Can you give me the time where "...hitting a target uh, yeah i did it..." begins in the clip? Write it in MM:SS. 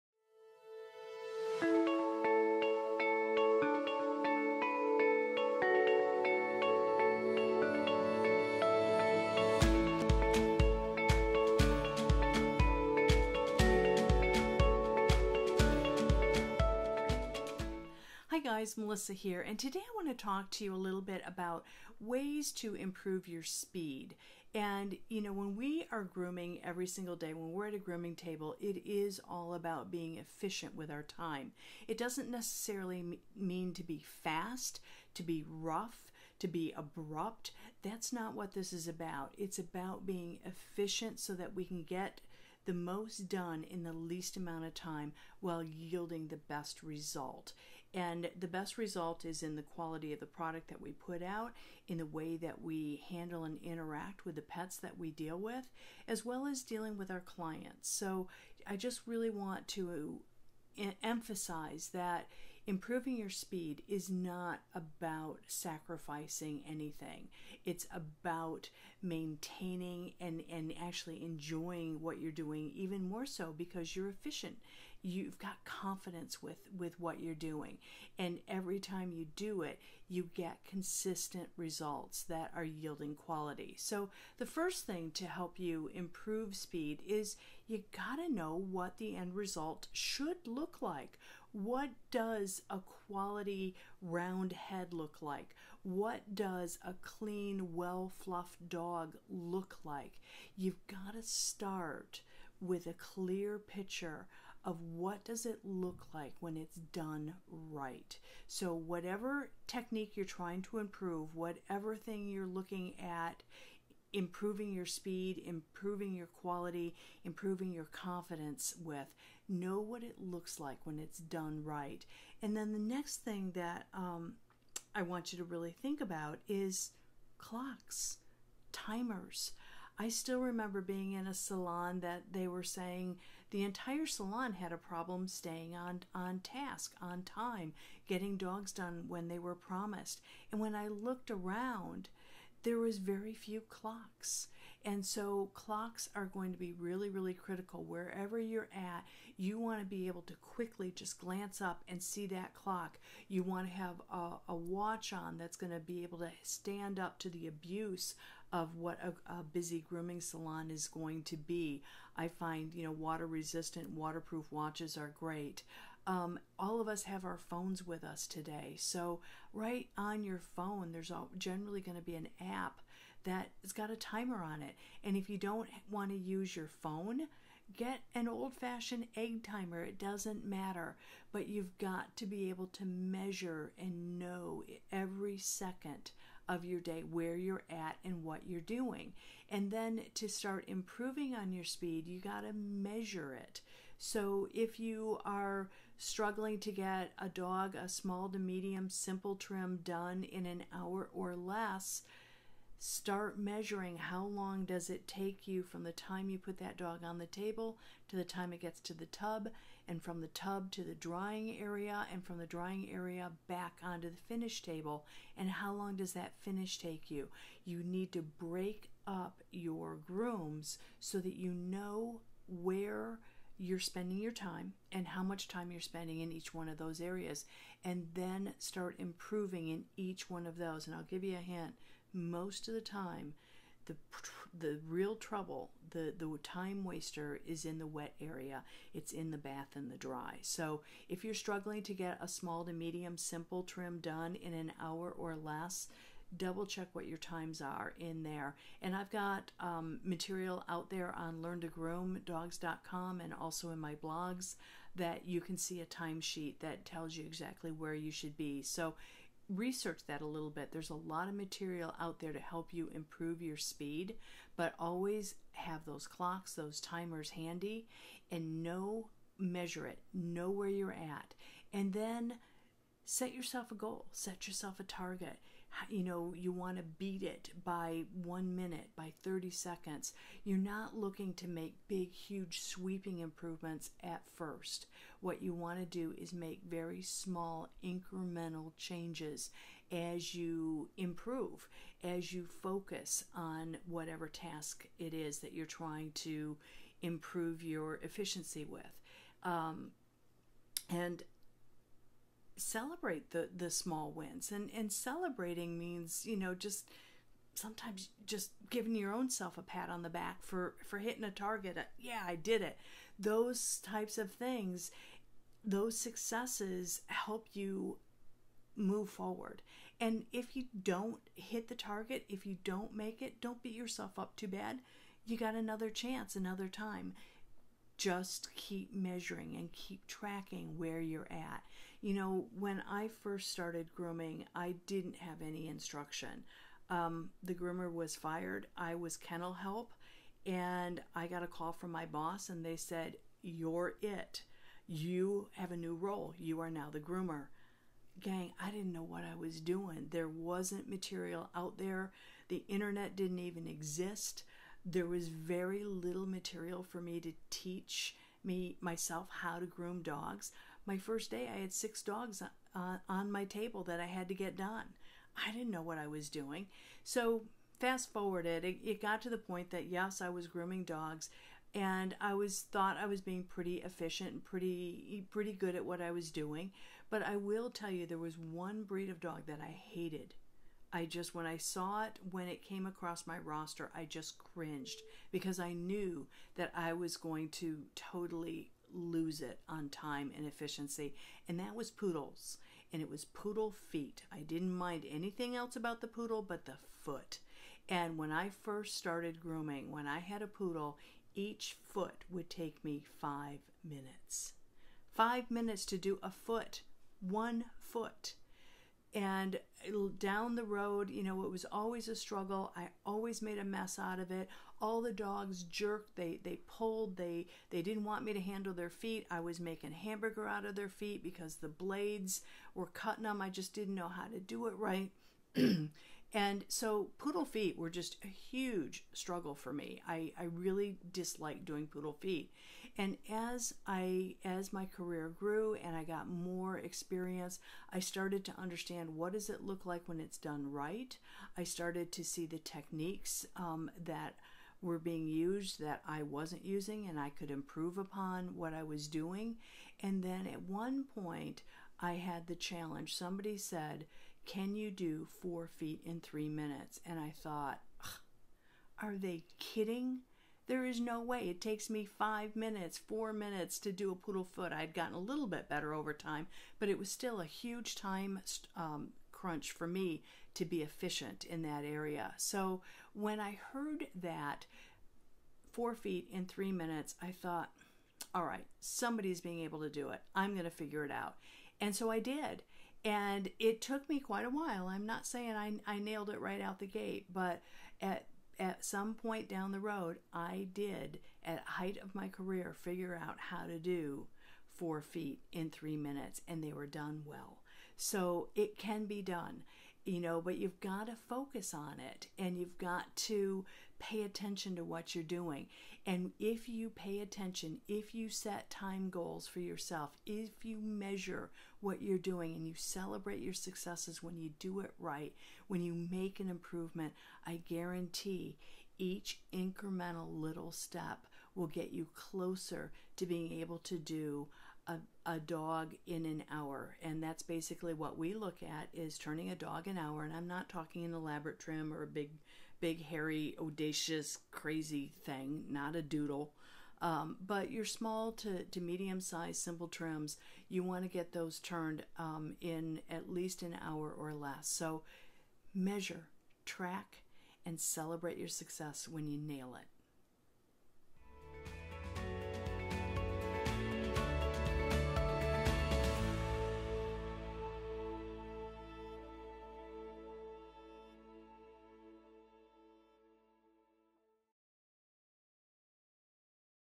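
05:10.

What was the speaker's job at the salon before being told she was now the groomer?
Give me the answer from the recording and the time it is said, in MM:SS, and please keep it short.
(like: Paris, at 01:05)
kennel help, at 05:39.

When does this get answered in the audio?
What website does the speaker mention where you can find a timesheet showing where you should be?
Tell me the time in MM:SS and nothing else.
04:11.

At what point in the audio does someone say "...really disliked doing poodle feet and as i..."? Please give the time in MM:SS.
07:10.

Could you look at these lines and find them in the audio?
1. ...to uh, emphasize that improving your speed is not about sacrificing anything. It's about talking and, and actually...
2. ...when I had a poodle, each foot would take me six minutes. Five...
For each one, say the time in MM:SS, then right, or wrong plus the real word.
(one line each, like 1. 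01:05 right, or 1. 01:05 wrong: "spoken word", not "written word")
1. 00:59 wrong: "maintaining", not "talking"
2. 06:39 wrong: "five", not "six".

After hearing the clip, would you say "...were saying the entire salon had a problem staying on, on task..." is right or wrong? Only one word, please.
right.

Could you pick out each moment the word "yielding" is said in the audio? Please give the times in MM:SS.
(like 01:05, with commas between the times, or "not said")
00:45, 01:22.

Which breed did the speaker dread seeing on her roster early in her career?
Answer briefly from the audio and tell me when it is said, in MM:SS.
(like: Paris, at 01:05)
poodles, at 06:31.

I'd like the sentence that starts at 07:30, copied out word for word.
And then at one point, I had the challenge.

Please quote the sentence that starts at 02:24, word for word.
And so clocks are going to be really, really critical.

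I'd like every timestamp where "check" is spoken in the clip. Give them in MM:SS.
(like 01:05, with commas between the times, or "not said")
04:06.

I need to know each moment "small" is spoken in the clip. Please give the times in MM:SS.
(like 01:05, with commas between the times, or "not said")
03:17, 04:02, 04:47, 05:03, 08:57.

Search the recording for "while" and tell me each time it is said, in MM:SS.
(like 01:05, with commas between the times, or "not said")
00:45, 08:04.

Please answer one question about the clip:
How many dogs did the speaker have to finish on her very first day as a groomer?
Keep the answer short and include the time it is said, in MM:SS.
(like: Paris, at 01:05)
6, at 06:01.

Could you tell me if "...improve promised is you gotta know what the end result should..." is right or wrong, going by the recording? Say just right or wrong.
wrong.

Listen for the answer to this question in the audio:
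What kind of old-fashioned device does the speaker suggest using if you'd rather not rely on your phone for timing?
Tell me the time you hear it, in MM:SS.
02:59.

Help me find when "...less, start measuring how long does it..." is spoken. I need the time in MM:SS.
03:21.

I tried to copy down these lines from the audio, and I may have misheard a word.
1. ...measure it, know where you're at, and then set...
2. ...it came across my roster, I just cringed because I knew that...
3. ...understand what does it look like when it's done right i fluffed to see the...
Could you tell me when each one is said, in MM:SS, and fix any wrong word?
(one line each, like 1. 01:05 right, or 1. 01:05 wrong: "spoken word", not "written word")
1. 04:29 right
2. 06:22 right
3. 07:18 wrong: "started", not "fluffed".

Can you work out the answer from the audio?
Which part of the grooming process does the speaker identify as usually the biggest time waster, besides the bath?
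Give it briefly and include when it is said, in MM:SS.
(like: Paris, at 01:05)
the dry, at 03:59.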